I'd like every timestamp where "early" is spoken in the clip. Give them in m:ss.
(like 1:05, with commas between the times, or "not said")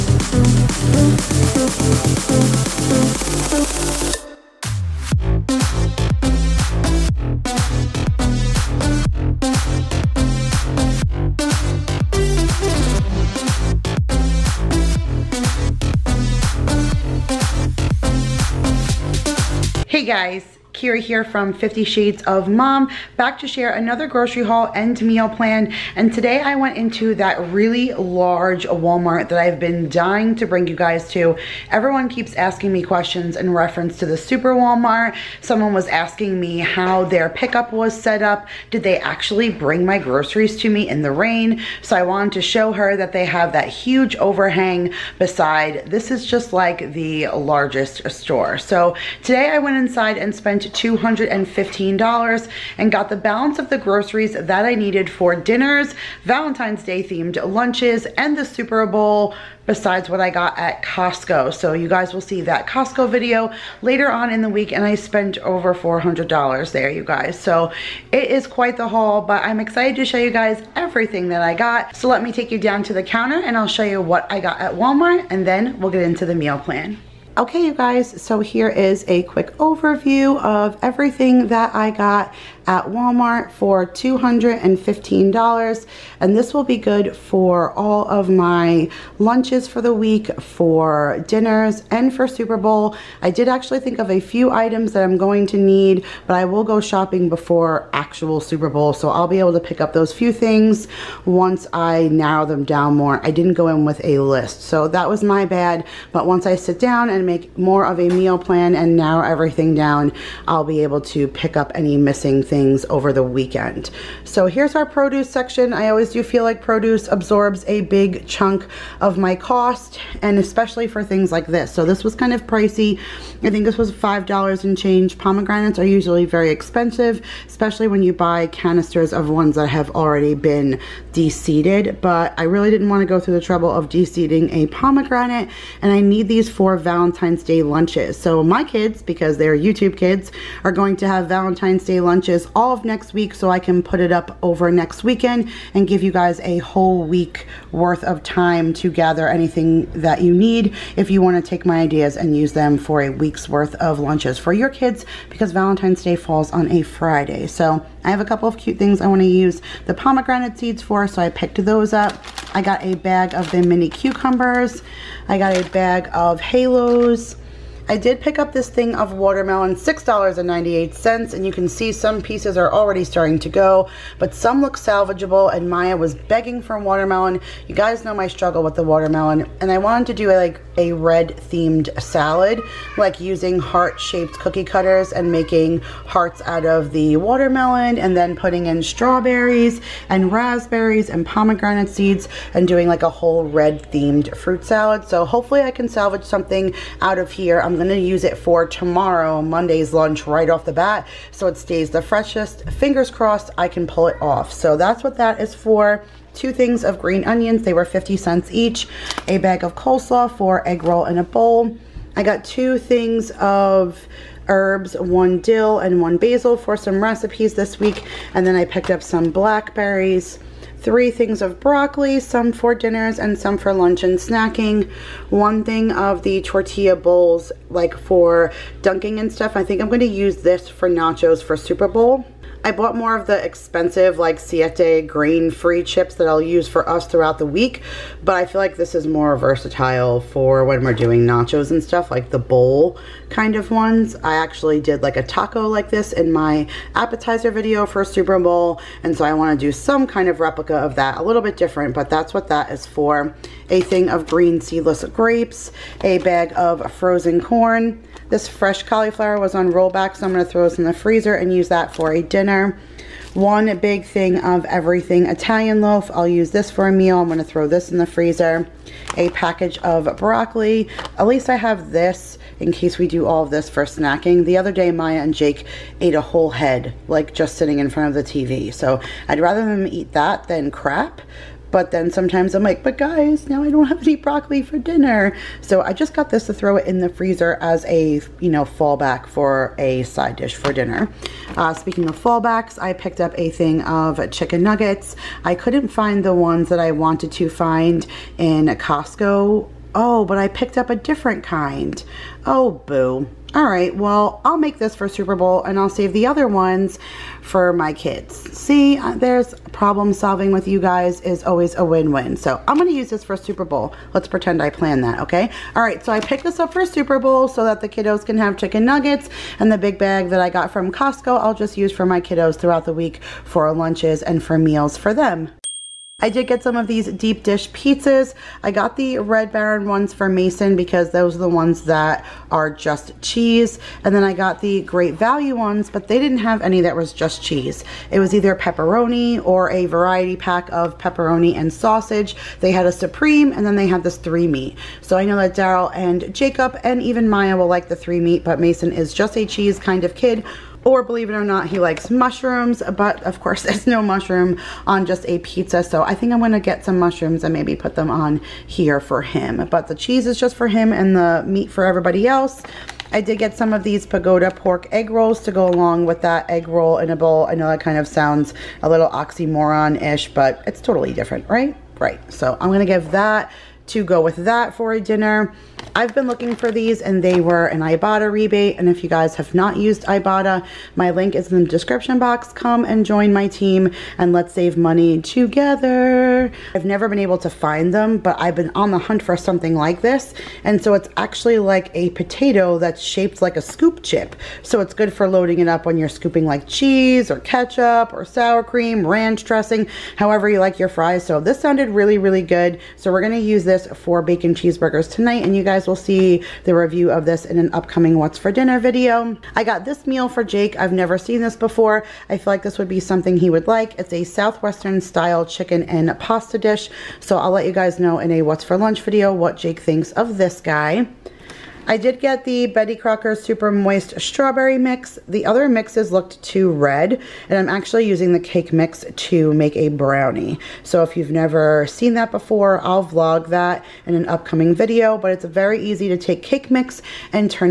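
not said.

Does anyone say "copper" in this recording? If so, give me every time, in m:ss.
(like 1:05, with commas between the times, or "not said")
not said.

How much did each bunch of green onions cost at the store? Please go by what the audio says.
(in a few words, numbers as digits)
50 cents.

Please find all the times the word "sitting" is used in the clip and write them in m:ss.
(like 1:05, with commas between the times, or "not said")
4:37.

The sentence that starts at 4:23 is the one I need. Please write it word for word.
One big thing of everything Italian loaf.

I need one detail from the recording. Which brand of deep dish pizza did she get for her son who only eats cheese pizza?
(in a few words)
Red Baron.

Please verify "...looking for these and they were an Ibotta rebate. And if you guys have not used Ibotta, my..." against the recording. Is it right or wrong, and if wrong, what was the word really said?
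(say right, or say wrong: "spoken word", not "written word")
right.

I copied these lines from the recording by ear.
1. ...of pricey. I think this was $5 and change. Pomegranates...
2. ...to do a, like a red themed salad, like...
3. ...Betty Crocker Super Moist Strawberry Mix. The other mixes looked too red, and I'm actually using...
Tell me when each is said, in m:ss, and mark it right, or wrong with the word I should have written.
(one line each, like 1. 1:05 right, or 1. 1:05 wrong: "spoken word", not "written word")
1. 2:02 right
2. 3:00 right
3. 7:02 right.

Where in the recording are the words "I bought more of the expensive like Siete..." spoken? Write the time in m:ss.
3:52.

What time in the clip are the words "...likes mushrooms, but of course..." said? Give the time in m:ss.
5:51.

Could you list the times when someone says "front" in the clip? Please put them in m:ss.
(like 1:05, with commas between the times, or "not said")
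4:37.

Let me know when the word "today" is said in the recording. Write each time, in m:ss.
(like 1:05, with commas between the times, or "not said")
0:26, 0:49.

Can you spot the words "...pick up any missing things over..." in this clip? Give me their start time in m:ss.
1:51.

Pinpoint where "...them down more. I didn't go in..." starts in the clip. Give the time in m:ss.
1:42.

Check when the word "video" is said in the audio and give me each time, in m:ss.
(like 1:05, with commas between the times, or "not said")
1:03, 4:07, 6:48, 6:59, 7:14.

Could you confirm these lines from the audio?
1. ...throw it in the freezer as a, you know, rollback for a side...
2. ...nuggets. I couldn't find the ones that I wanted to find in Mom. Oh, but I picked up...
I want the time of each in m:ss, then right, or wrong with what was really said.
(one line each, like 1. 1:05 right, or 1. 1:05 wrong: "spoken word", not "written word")
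1. 4:46 wrong: "fallback", not "rollback"
2. 4:54 wrong: "Costco", not "Mom".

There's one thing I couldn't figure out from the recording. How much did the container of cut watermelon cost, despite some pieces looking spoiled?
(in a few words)
$6.98.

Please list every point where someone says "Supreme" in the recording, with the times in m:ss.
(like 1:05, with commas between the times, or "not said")
5:42.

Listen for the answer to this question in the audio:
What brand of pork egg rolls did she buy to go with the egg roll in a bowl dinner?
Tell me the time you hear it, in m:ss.
6:04.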